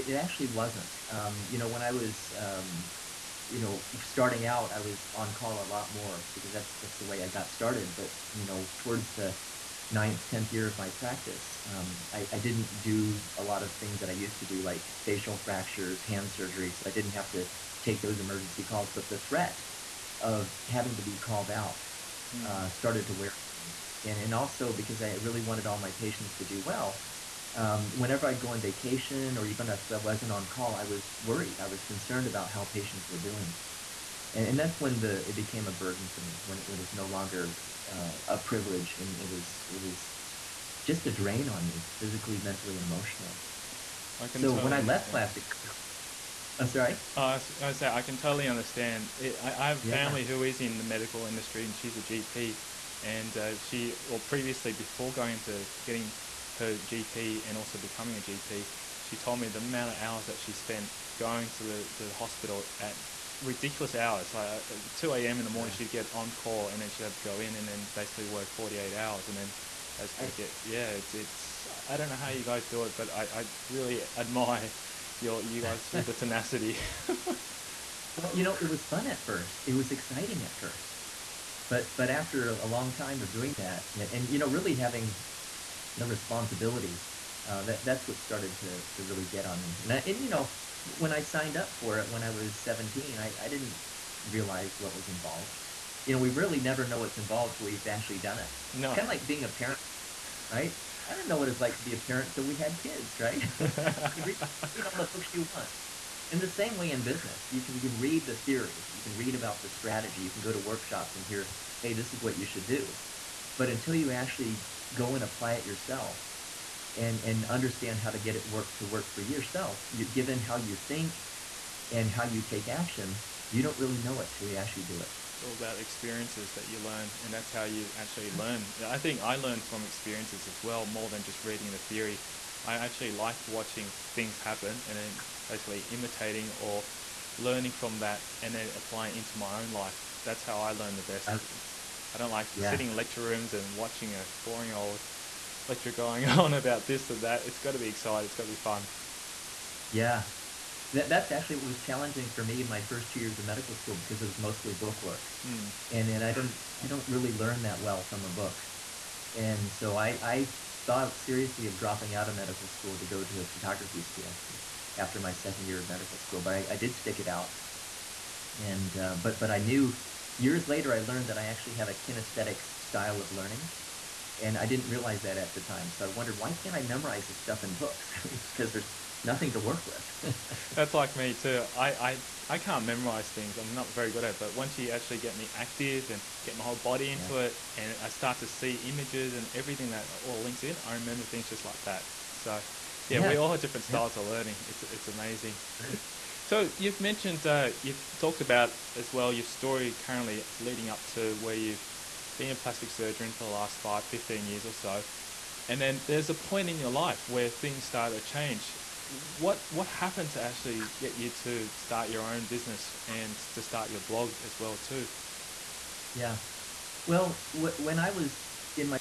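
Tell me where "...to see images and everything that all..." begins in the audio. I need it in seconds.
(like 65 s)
188 s.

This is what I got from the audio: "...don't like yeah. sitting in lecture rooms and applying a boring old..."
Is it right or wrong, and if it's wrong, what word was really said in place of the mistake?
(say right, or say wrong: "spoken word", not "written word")
wrong: "watching", not "applying".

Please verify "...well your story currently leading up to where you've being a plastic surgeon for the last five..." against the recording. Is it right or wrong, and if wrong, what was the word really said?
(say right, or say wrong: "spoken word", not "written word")
right.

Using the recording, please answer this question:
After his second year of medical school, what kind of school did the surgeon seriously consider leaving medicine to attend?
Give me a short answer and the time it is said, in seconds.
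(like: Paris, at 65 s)
Photography school, at 163 s.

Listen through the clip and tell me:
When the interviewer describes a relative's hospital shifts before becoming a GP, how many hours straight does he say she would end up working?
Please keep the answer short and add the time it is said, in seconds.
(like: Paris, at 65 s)
48 hours, at 68 s.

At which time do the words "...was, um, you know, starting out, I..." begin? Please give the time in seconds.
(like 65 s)
1 s.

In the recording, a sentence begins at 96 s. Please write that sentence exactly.
You know, we really never know what's involved till we've actually done it.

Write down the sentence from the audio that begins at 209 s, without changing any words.
What what happened to actually get you to start your own business and to start your blog as well too?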